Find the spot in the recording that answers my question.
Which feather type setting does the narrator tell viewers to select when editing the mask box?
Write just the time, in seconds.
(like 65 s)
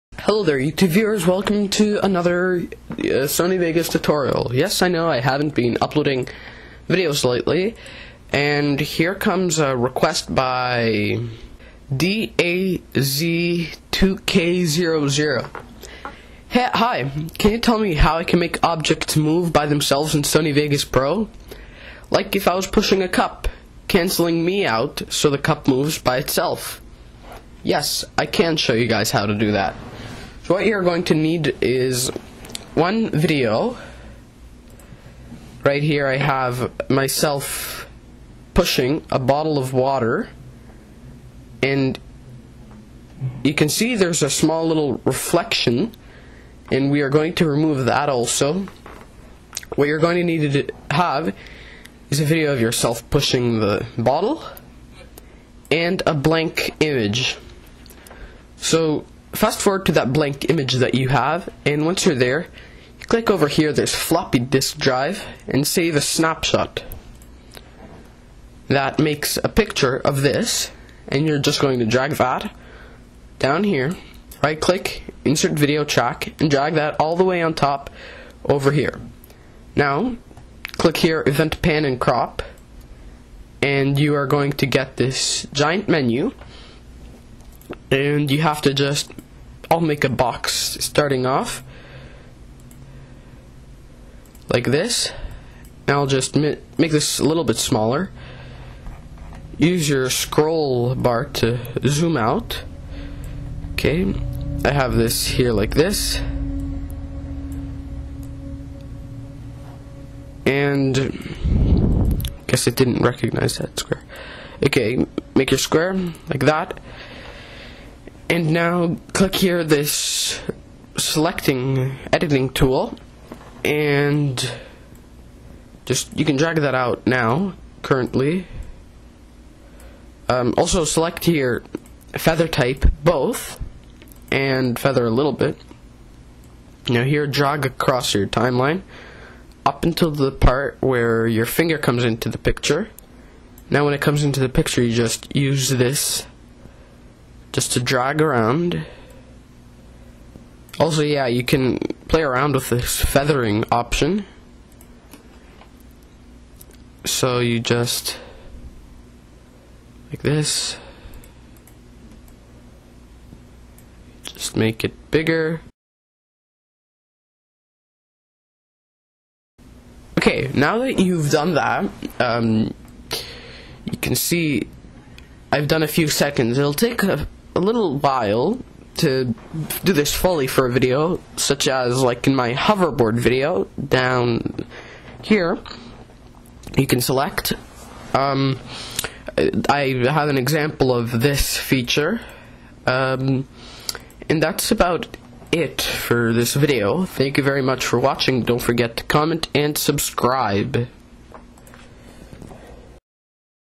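133 s.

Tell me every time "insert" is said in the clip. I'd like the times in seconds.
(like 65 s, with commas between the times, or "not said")
75 s.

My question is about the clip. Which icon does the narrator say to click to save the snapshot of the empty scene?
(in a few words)
Floppy disk drive.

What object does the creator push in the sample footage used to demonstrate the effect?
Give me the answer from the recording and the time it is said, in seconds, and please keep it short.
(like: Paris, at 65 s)
A bottle of water, at 39 s.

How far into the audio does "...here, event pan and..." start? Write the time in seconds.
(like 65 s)
80 s.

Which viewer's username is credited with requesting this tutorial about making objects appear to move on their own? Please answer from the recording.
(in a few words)
DAZ2K00.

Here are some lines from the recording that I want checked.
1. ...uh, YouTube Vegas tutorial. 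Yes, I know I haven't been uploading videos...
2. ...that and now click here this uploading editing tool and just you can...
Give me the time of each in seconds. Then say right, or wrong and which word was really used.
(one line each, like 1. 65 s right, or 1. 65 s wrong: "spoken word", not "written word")
1. 2 s wrong: "Sony", not "YouTube"
2. 116 s wrong: "selecting", not "uploading".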